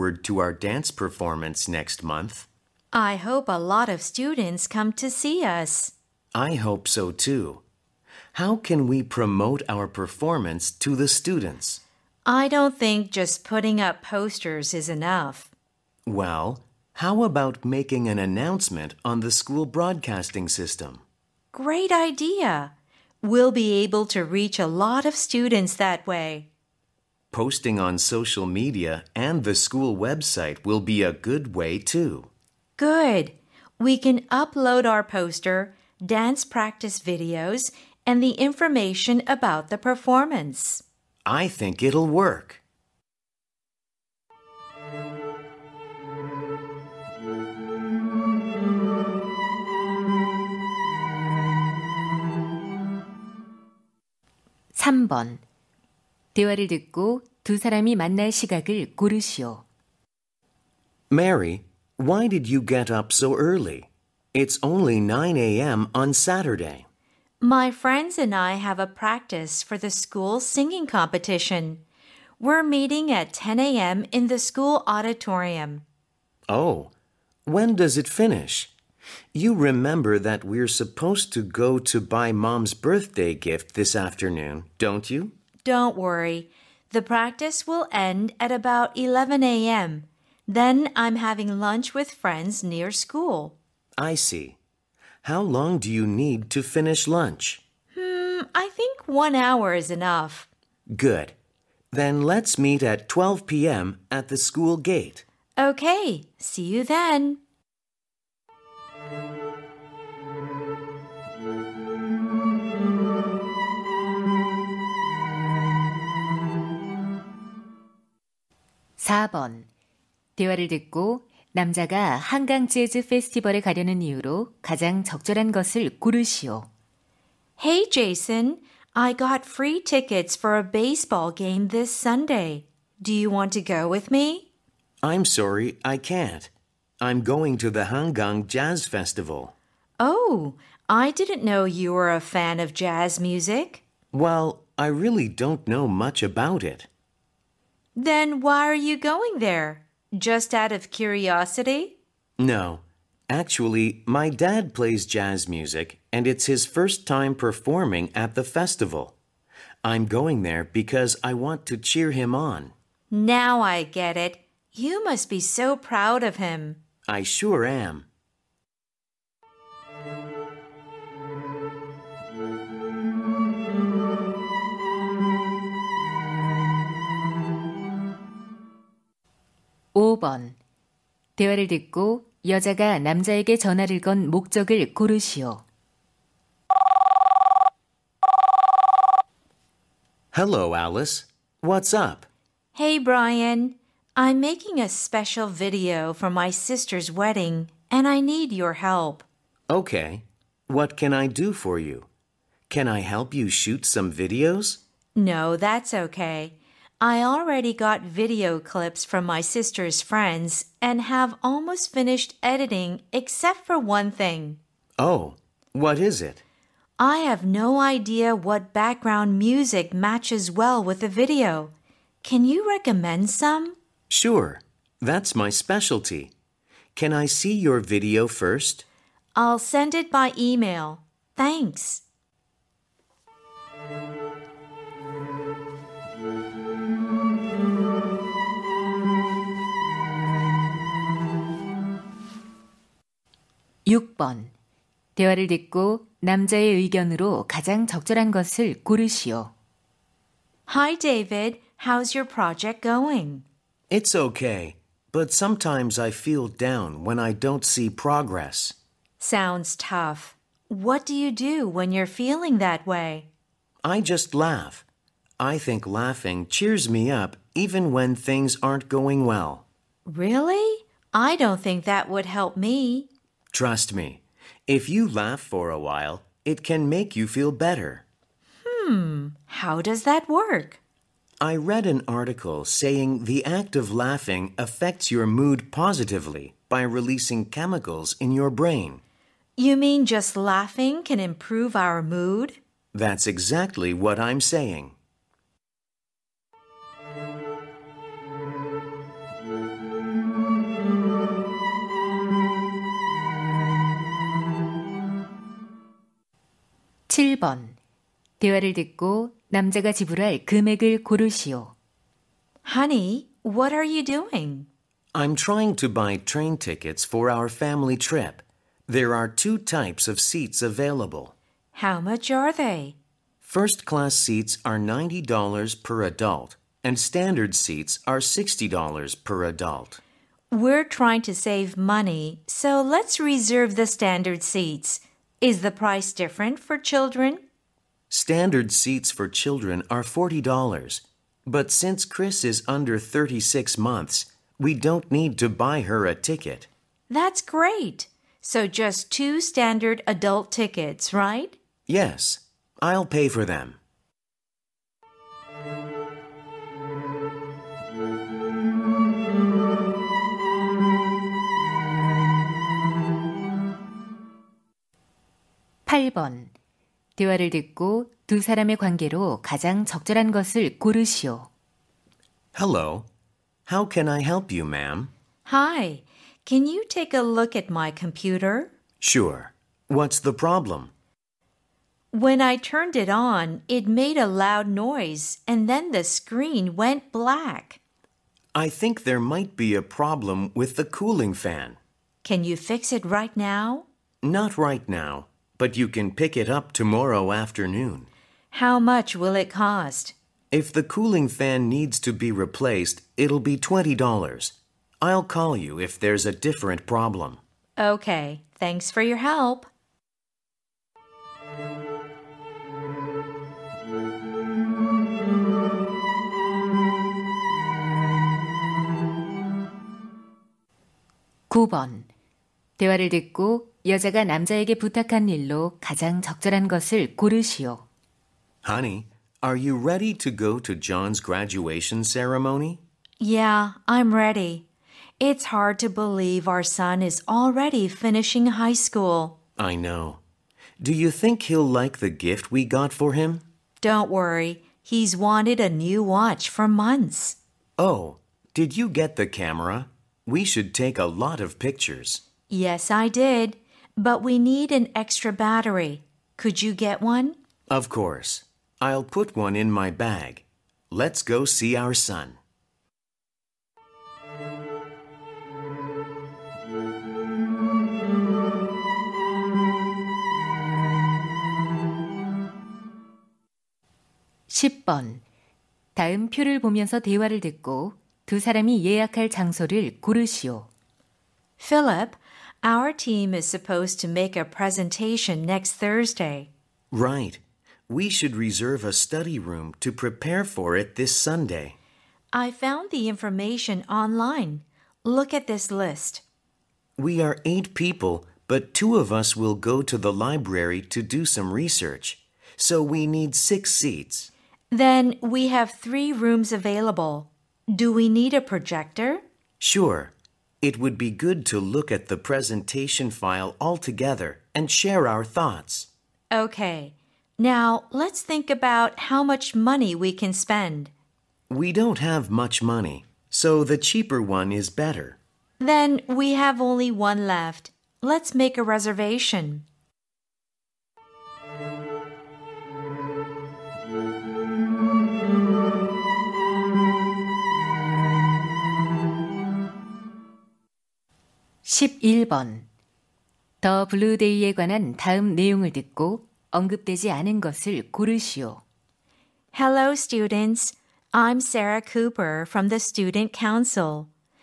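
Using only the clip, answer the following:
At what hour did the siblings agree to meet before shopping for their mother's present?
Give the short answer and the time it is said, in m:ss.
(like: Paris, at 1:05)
12 p.m., at 1:43.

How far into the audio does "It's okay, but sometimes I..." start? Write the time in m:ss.
4:13.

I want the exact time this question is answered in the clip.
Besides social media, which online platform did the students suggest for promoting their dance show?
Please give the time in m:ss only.
0:29.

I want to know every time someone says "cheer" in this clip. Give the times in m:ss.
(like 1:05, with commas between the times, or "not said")
2:41, 4:26.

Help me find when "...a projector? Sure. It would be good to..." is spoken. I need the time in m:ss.
8:28.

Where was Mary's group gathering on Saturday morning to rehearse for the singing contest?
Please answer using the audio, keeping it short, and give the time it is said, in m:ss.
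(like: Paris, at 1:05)
School auditorium, at 1:14.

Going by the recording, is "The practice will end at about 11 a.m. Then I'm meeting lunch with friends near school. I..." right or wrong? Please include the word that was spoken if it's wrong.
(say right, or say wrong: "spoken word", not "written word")
wrong: "having", not "meeting".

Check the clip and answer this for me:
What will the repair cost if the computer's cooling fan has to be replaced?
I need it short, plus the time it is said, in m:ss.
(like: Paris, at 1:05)
$20, at 6:43.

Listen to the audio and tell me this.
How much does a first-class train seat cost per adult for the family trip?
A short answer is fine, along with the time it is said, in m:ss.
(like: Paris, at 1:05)
$90, at 5:24.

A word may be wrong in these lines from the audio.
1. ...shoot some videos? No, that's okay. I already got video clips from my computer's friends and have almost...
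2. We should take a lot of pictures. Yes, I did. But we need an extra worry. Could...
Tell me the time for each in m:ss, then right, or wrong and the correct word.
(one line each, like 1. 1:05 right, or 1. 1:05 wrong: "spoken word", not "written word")
1. 3:23 wrong: "sister", not "computer"
2. 7:30 wrong: "battery", not "worry".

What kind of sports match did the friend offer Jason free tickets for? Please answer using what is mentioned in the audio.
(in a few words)
Baseball.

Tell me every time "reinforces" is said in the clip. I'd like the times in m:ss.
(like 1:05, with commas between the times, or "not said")
not said.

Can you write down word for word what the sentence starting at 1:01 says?
Mary, why did you get up so early?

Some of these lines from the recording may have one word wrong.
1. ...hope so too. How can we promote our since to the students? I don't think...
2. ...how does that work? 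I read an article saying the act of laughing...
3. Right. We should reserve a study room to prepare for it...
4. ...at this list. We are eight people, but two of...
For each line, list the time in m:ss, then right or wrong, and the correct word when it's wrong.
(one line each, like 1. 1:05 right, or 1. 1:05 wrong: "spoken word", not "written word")
1. 0:06 wrong: "performance", not "since"
2. 4:39 right
3. 8:06 right
4. 8:15 right.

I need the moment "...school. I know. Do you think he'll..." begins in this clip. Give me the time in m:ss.
7:18.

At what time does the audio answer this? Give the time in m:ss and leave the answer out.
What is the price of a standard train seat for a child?
5:40.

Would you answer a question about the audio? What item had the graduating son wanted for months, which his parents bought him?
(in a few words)
A new watch.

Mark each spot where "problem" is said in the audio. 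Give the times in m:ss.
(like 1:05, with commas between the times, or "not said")
6:20, 6:29, 6:46.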